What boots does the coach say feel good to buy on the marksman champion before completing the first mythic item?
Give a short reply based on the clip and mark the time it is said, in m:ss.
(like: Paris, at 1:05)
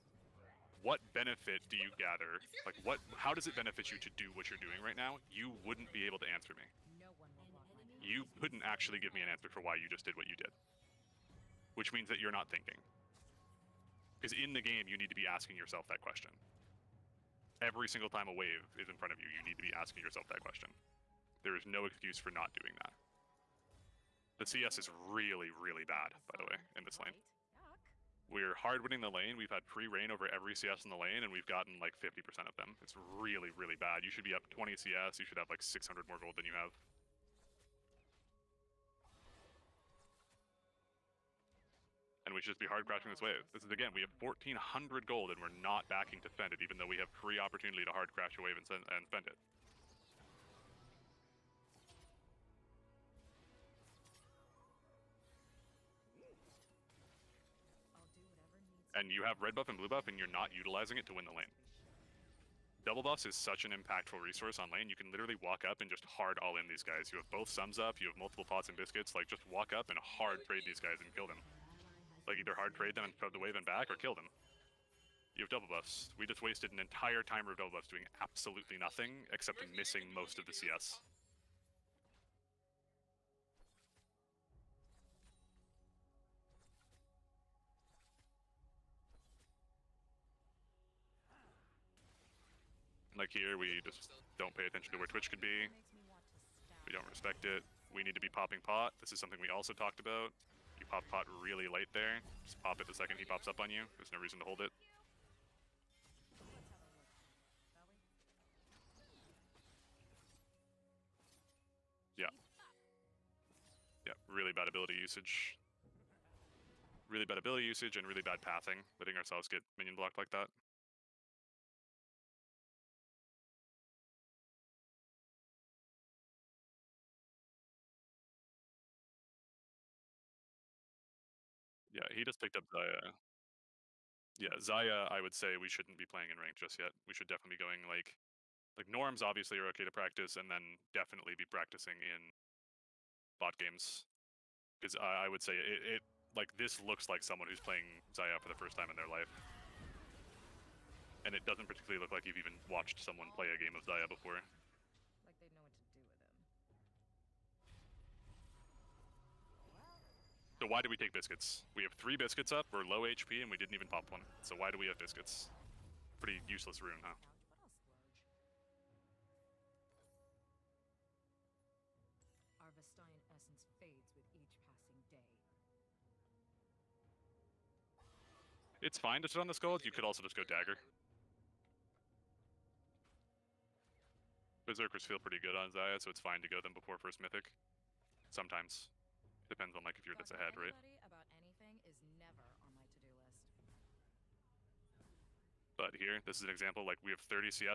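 Berserkers, at 3:04.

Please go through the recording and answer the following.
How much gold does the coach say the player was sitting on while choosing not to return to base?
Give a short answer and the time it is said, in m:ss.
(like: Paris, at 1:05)
1400, at 0:44.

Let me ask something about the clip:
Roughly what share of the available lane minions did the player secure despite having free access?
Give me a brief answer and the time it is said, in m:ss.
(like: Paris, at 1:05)
50%, at 0:32.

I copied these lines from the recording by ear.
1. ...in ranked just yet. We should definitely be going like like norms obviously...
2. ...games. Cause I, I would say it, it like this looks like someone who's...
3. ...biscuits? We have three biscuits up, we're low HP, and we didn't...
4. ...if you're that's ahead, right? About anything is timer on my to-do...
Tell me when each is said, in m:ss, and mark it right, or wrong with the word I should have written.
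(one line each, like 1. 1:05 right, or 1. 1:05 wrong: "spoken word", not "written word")
1. 2:16 right
2. 2:23 right
3. 2:41 right
4. 3:09 wrong: "never", not "timer".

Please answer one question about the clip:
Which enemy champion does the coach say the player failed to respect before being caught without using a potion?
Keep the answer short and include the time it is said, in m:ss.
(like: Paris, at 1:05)
Twitch, at 1:35.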